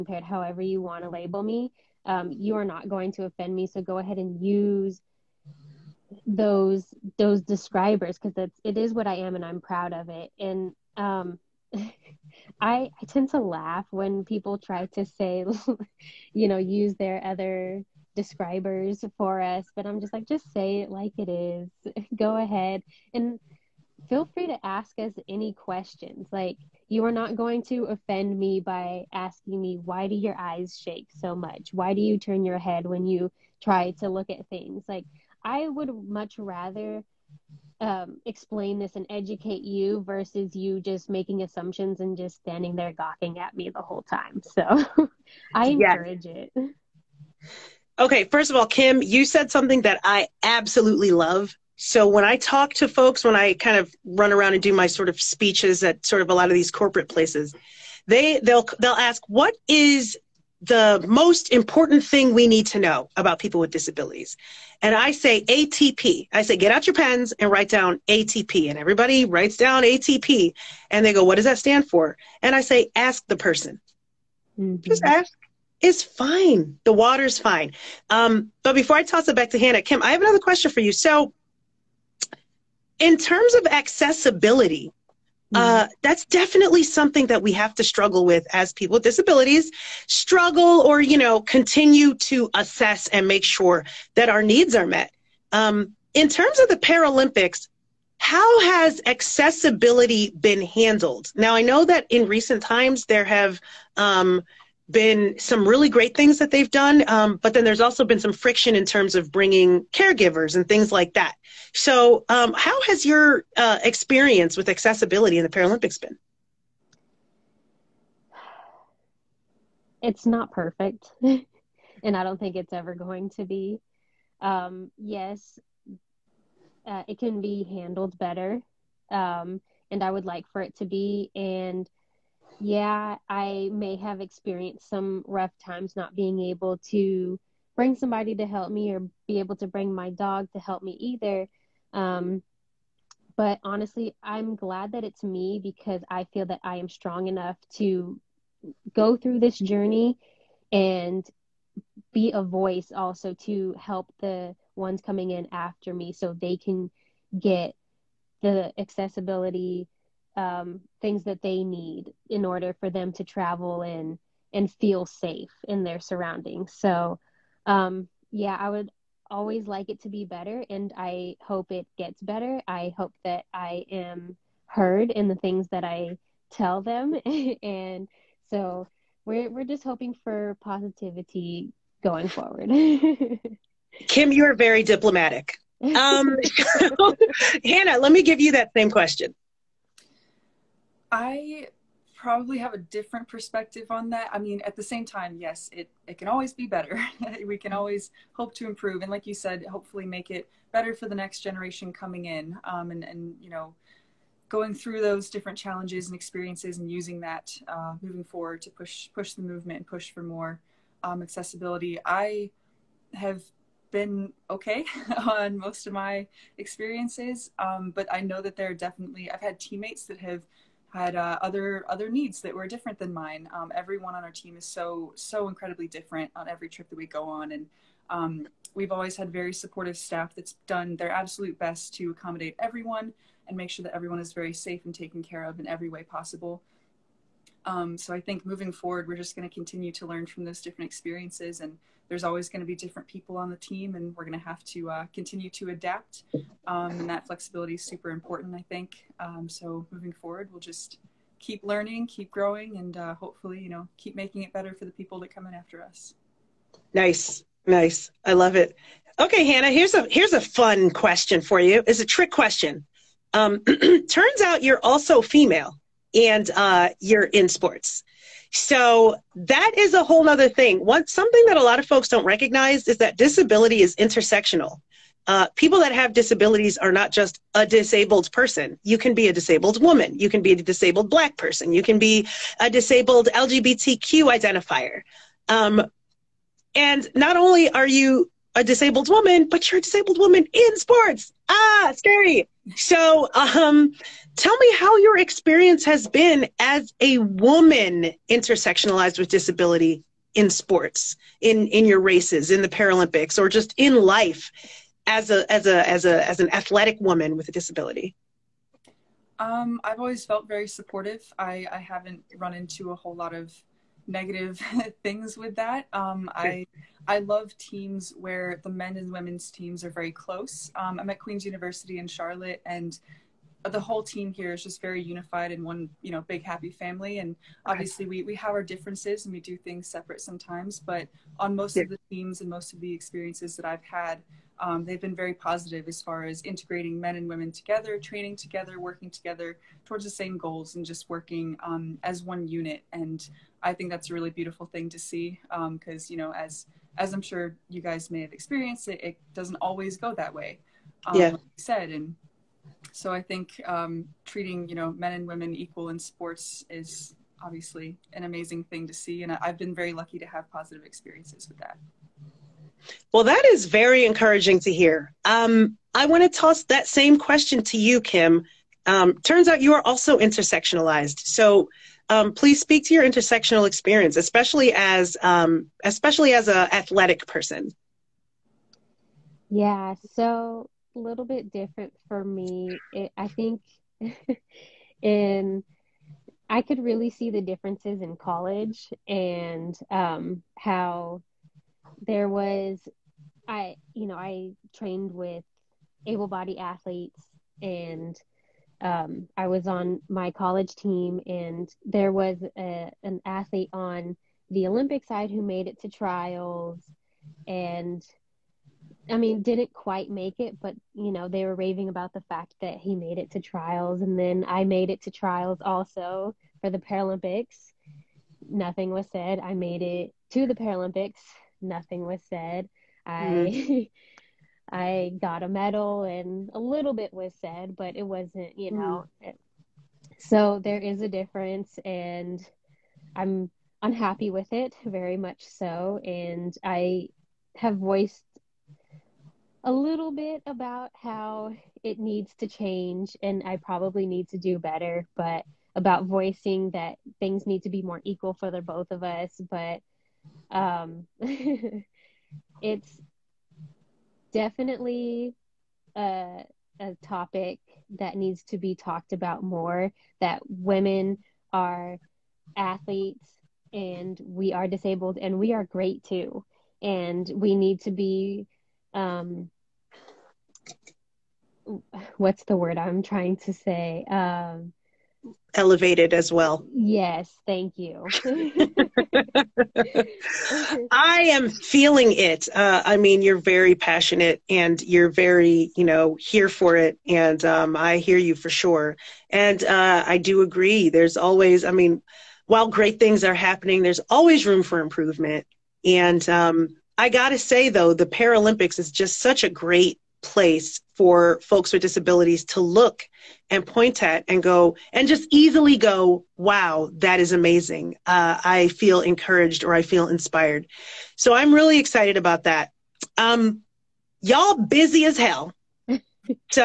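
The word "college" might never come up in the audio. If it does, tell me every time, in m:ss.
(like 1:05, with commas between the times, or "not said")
6:28, 6:40.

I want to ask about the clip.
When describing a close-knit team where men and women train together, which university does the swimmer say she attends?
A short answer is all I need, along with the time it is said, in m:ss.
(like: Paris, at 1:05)
Queen's University, at 5:21.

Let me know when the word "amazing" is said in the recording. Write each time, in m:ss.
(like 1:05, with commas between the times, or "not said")
5:58, 8:27.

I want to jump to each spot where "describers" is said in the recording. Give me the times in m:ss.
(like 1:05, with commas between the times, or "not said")
0:07, 0:18.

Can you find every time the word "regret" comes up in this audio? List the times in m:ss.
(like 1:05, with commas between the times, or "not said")
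not said.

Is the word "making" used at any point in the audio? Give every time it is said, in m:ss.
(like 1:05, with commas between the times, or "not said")
0:41, 4:14.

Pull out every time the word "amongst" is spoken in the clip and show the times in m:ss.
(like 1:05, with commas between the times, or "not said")
not said.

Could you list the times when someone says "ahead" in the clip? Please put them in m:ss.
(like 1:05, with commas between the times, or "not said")
0:03, 0:22.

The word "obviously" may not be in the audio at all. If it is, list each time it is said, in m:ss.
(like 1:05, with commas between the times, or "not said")
5:27, 5:57.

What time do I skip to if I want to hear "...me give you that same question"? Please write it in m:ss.
3:08.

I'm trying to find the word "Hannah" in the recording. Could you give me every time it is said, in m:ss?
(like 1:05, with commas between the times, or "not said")
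1:19, 3:07, 4:19.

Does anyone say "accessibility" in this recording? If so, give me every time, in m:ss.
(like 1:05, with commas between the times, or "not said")
1:23, 1:39, 1:54, 2:38, 3:31.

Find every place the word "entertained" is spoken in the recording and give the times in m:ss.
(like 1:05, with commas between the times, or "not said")
not said.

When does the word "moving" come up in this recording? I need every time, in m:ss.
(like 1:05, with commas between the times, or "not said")
3:28, 3:58, 4:09.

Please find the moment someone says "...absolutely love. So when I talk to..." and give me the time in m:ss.
0:50.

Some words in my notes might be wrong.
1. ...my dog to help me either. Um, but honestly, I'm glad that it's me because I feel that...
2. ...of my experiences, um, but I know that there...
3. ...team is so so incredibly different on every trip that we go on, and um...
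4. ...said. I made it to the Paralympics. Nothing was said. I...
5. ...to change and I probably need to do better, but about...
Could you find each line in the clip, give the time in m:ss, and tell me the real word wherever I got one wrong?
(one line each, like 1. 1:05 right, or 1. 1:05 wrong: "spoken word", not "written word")
1. 2:19 right
2. 3:35 right
3. 3:44 right
4. 6:59 right
5. 7:22 right.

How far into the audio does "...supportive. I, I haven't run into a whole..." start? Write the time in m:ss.
5:10.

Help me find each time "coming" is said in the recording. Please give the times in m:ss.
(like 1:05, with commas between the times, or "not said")
2:35, 3:21.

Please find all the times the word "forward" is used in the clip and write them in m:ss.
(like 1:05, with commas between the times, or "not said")
3:02, 3:28, 3:58, 4:10.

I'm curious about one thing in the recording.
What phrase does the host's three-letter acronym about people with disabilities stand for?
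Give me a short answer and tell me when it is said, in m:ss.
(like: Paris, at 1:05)
Ask the person, at 1:12.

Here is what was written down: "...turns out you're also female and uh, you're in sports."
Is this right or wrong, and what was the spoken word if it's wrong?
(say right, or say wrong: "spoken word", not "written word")
right.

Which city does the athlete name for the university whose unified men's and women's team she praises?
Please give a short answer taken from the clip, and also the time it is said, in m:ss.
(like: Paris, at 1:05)
Charlotte, at 5:22.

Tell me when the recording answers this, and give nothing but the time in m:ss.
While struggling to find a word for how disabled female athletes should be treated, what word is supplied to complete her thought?
7:55.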